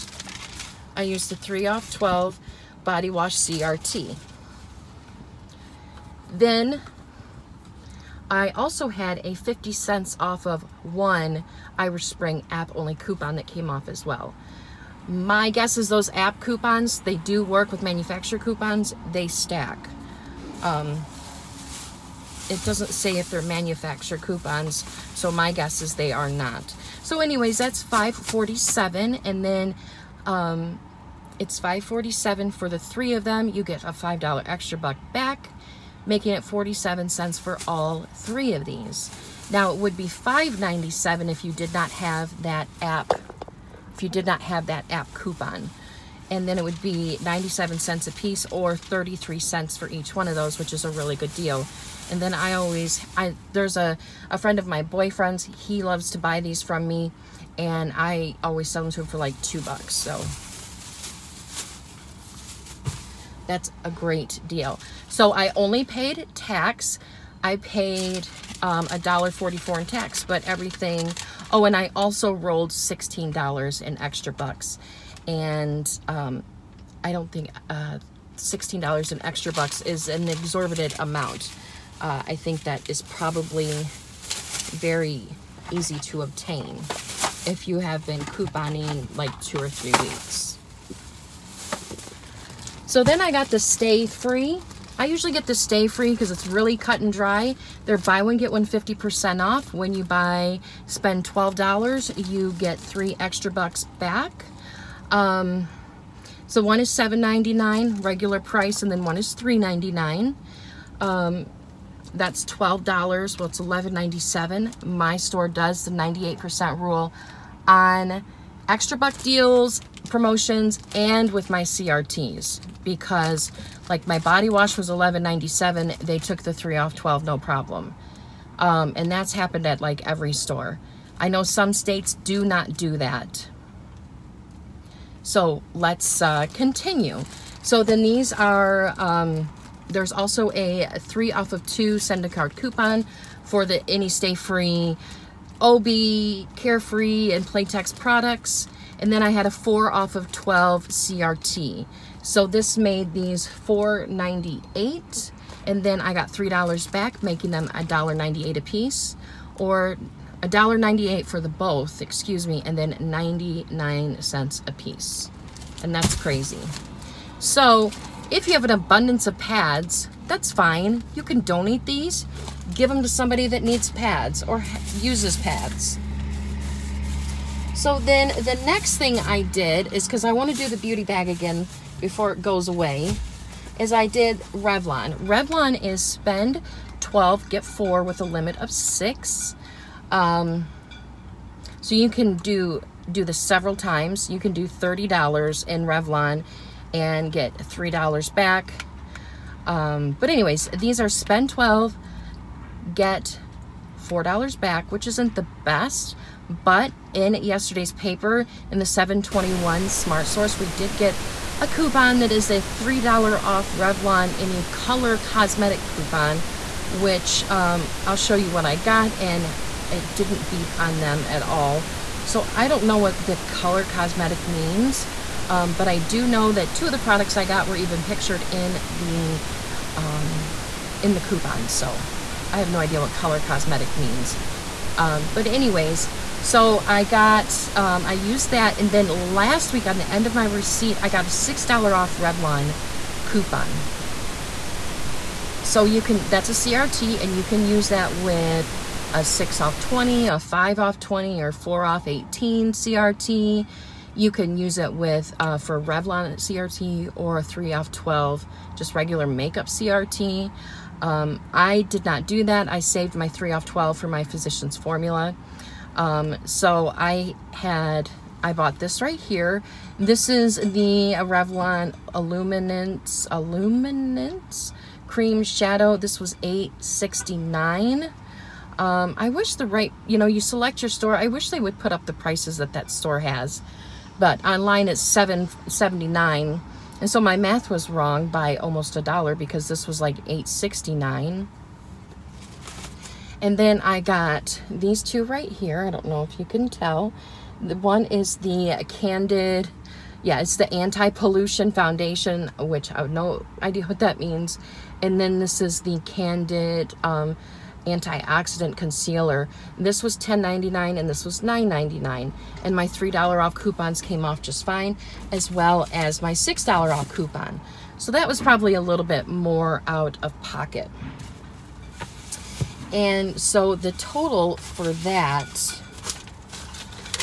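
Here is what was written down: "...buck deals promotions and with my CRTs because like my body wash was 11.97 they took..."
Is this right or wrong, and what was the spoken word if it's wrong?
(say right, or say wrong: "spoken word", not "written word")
right.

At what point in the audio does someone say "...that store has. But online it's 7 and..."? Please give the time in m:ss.
4:42.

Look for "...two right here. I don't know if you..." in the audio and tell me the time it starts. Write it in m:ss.
4:55.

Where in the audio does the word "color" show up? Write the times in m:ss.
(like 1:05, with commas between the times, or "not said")
3:34, 3:43, 3:53.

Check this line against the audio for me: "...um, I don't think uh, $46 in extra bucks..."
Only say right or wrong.
wrong.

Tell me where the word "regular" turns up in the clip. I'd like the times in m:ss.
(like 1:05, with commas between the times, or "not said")
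1:48, 4:18.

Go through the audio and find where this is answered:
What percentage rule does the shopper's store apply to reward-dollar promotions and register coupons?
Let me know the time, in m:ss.
1:55.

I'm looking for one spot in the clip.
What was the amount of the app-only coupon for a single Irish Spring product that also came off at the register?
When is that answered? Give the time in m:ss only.
0:09.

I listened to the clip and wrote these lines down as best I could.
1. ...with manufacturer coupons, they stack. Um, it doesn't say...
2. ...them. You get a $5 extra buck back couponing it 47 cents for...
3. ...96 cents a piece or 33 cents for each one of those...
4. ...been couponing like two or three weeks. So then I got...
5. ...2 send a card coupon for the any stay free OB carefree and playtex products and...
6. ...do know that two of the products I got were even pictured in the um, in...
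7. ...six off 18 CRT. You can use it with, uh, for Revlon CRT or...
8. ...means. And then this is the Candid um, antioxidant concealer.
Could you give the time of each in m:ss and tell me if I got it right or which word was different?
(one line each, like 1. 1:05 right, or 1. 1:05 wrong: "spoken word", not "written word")
1. 0:17 right
2. 0:33 wrong: "making", not "couponing"
3. 0:47 wrong: "97", not "96"
4. 1:28 right
5. 2:21 right
6. 3:45 right
7. 4:11 wrong: "four", not "six"
8. 5:04 right.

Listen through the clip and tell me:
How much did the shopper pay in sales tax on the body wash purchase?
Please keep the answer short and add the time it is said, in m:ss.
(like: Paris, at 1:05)
$1.44, at 1:08.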